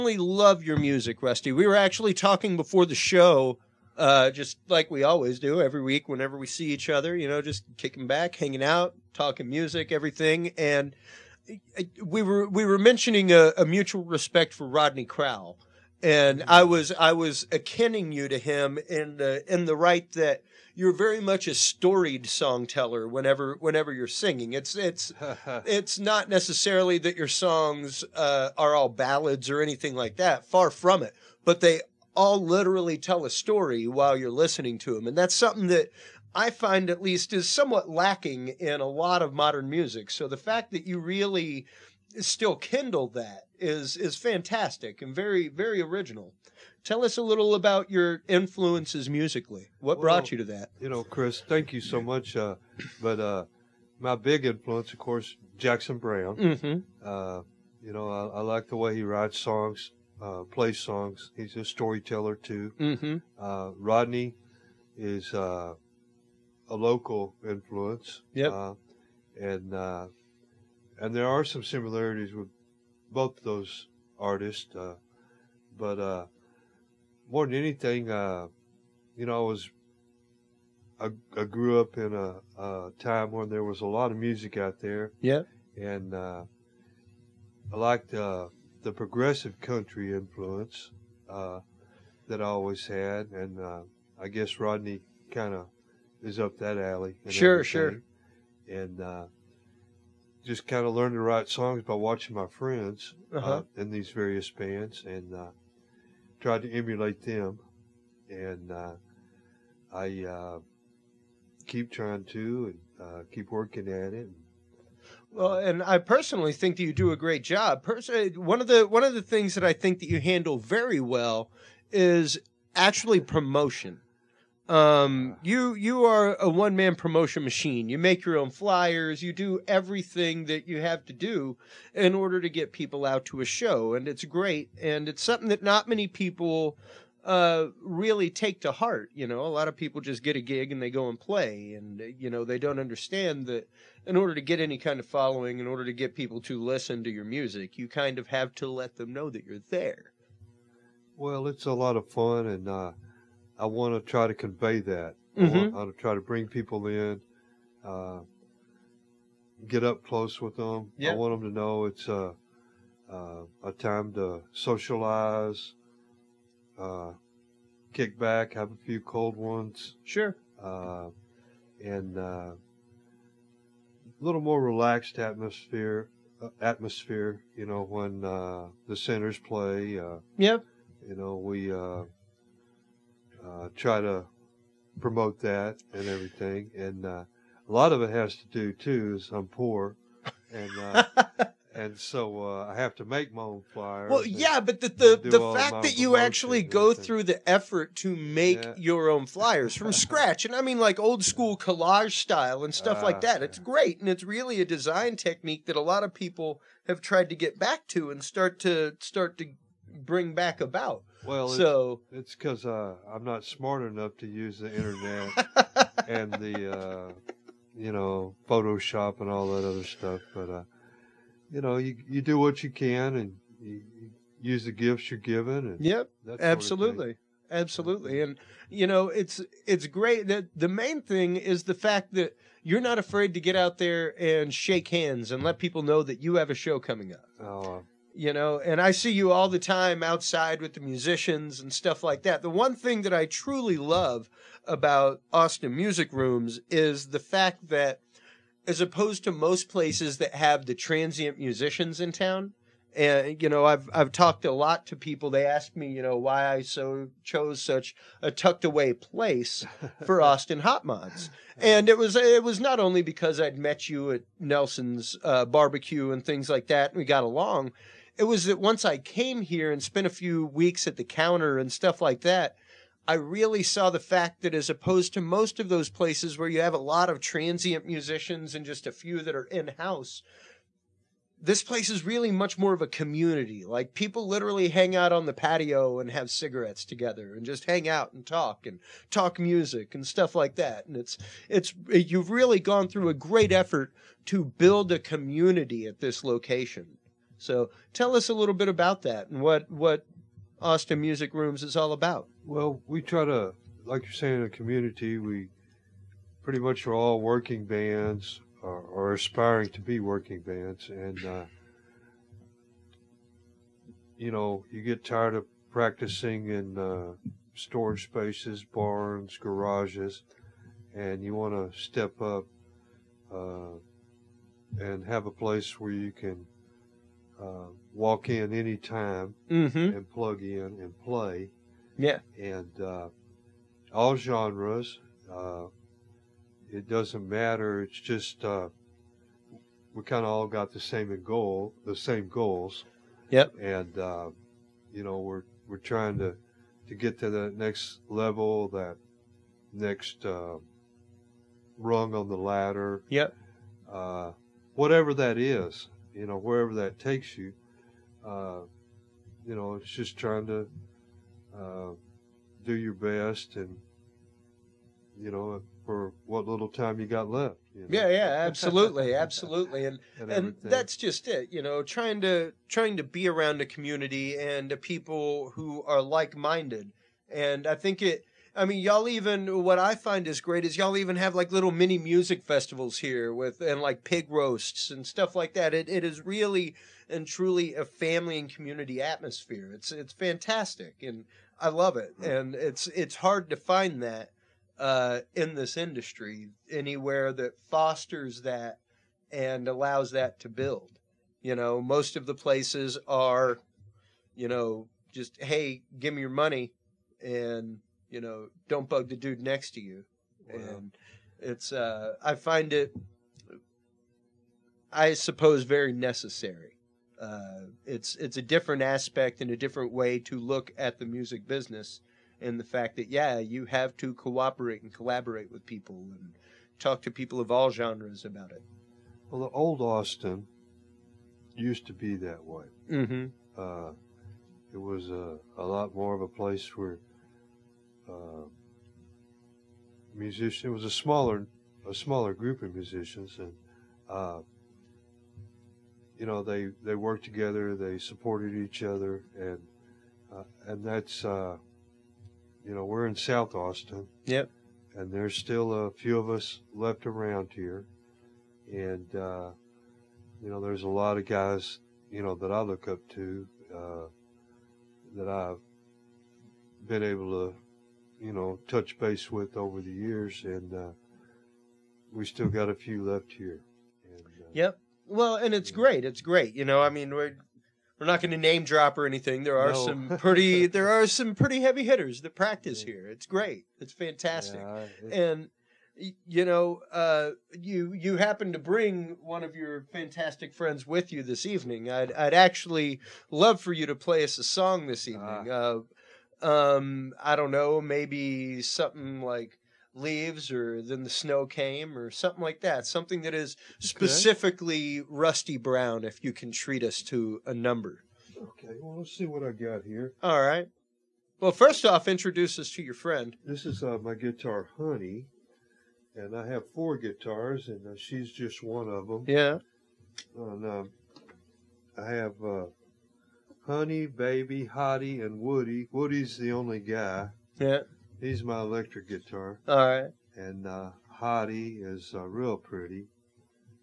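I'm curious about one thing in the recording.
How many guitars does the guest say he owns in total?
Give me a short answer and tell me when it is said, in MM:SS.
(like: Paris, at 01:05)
4, at 08:36.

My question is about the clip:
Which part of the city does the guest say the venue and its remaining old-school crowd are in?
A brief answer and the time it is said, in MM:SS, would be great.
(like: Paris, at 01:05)
South Austin, at 07:33.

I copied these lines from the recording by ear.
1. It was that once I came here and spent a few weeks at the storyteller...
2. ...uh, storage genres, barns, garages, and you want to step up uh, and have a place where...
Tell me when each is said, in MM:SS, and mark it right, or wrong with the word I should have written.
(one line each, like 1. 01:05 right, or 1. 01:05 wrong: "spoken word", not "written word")
1. 04:28 wrong: "counter", not "storyteller"
2. 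05:16 wrong: "spaces", not "genres".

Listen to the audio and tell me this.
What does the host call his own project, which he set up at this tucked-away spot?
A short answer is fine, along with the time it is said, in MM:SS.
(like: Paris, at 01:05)
Austin Hot Mods, at 04:20.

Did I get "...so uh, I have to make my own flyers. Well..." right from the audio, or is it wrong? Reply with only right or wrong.
right.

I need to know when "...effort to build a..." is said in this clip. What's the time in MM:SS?
04:53.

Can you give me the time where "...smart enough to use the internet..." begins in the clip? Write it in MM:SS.
03:33.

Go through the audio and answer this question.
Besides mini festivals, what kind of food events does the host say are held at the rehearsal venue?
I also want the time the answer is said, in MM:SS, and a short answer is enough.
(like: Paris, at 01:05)
Pig roasts, at 06:24.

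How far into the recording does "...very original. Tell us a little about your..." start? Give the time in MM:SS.
00:45.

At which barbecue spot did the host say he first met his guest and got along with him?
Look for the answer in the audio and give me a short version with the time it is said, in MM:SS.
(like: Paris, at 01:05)
Nelson's, at 04:24.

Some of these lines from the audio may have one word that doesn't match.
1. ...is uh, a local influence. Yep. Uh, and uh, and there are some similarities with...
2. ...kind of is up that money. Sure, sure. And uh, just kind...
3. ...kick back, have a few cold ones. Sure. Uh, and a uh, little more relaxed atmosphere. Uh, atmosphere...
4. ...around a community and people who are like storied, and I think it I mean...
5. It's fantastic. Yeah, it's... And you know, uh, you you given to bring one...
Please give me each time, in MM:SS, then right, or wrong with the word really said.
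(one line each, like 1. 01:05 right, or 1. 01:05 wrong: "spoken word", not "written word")
1. 01:04 right
2. 01:35 wrong: "alley", not "money"
3. 02:47 right
4. 06:13 wrong: "minded", not "storied"
5. 08:03 wrong: "happen", not "given".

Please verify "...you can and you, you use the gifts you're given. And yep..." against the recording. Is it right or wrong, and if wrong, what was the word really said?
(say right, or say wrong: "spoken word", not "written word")
right.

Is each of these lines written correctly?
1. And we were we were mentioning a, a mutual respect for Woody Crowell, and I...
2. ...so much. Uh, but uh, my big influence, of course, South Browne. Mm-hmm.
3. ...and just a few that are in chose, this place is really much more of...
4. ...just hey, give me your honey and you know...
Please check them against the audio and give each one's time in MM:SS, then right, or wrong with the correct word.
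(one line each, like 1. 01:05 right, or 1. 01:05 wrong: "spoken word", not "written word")
1. 00:10 wrong: "Rodney", not "Woody"
2. 00:51 wrong: "Jackson", not "South"
3. 04:38 wrong: "house", not "chose"
4. 06:45 wrong: "money", not "honey".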